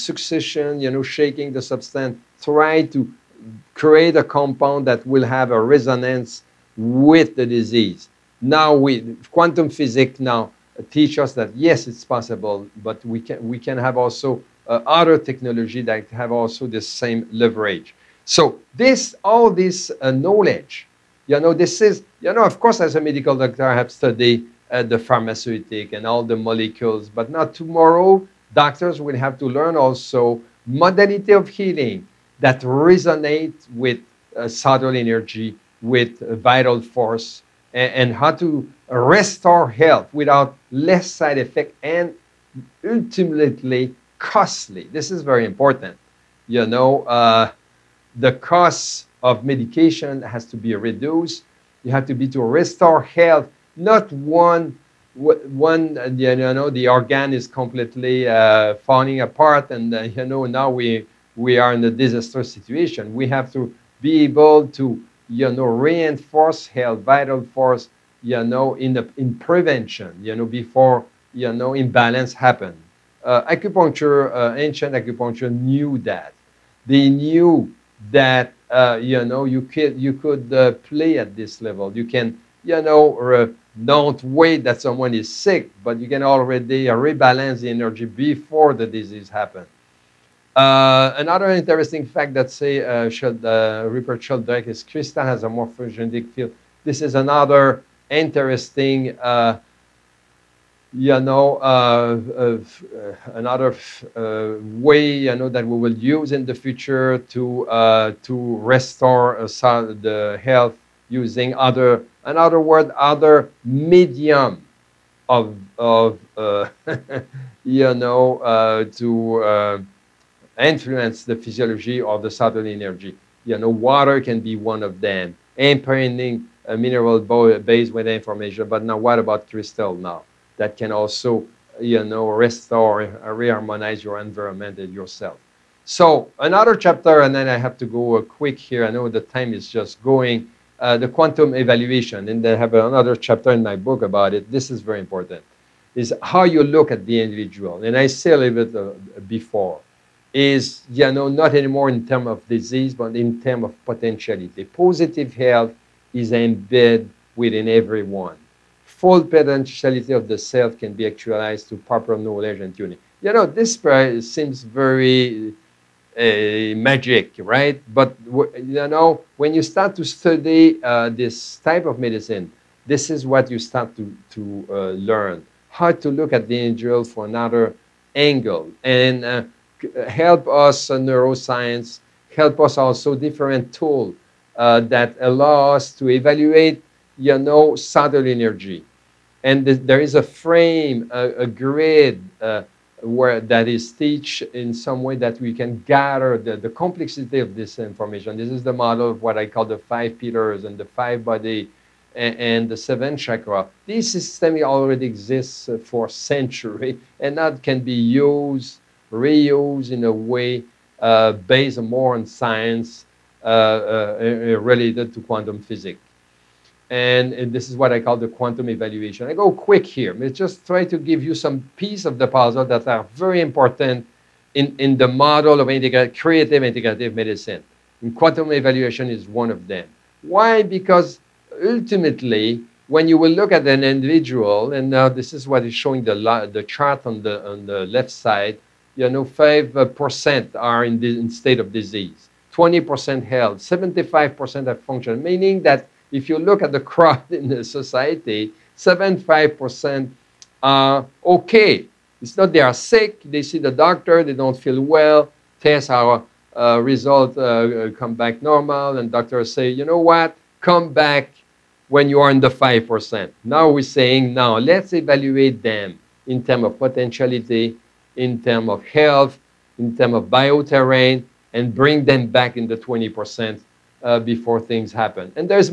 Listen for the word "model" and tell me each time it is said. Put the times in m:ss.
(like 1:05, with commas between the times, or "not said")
3:18, 3:45.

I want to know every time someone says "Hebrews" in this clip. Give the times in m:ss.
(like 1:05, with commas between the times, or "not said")
not said.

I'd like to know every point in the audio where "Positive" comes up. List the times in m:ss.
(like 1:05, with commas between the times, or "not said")
2:34.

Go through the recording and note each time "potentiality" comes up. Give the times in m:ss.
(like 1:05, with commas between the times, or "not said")
2:33, 2:39, 4:26.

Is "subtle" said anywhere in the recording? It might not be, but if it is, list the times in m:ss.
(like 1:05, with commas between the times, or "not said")
0:34, 2:02, 3:07.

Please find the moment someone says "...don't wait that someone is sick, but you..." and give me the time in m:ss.
1:23.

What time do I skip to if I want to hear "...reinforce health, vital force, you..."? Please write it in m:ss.
1:05.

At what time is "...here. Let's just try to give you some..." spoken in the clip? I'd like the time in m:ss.
3:39.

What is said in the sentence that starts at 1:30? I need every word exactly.
Uh, another interesting fact that say uh, uh, Rupert Sheldrake is crystal has a morphogenic field.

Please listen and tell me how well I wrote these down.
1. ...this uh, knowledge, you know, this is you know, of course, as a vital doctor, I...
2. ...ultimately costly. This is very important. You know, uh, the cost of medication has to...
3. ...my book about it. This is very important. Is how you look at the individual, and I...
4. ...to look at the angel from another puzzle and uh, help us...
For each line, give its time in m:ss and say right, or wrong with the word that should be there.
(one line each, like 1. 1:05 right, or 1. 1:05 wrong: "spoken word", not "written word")
1. 0:19 wrong: "medical", not "vital"
2. 0:42 right
3. 2:23 right
4. 2:55 wrong: "angle", not "puzzle".